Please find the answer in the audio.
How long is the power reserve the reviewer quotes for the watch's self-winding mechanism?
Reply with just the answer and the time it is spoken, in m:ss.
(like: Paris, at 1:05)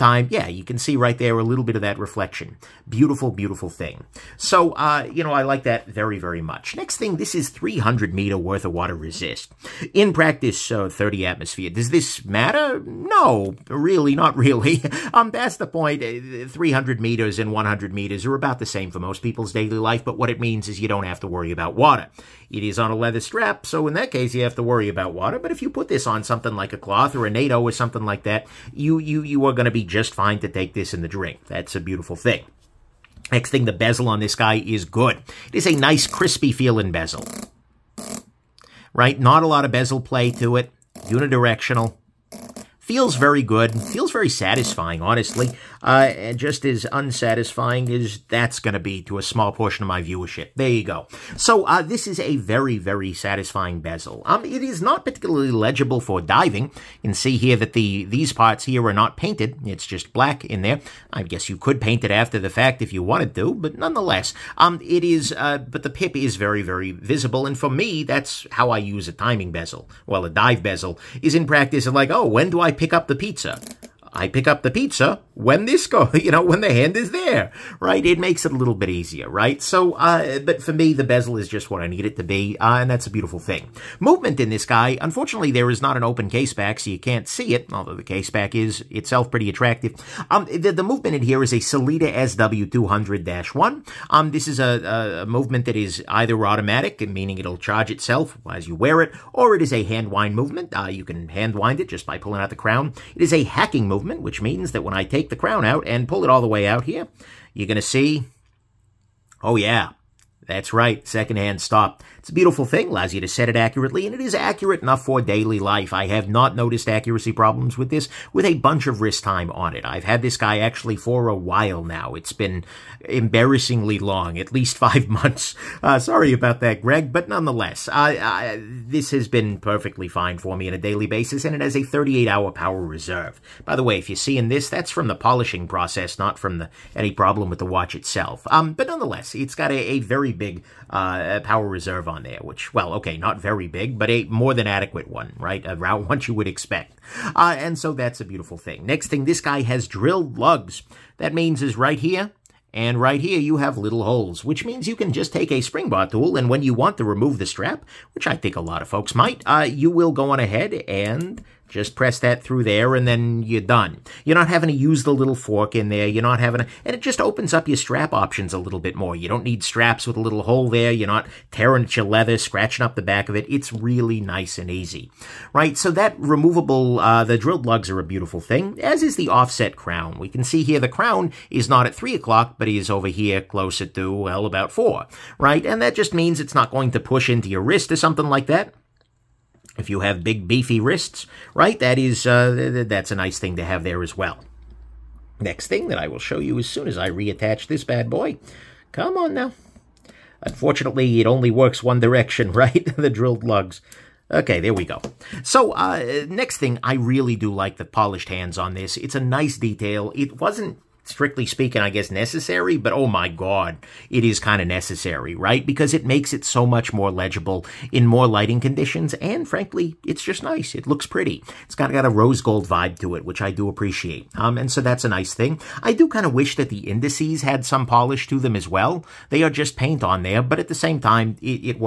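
38 hours, at 2:11.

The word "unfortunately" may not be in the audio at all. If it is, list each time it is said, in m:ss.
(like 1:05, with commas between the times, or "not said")
1:24, 3:20.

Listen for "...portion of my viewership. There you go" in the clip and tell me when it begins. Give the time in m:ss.
0:49.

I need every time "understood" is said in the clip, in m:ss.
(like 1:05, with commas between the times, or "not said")
not said.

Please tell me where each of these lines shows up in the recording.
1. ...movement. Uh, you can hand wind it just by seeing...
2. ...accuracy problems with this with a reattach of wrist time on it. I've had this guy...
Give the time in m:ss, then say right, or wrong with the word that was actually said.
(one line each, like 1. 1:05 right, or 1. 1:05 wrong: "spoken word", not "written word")
1. 1:40 wrong: "pulling", not "seeing"
2. 1:56 wrong: "bunch", not "reattach".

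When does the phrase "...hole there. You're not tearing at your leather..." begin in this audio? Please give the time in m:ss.
2:50.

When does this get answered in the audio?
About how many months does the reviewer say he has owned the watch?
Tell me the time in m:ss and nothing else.
2:04.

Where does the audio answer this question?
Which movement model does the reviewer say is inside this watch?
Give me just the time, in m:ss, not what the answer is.
1:31.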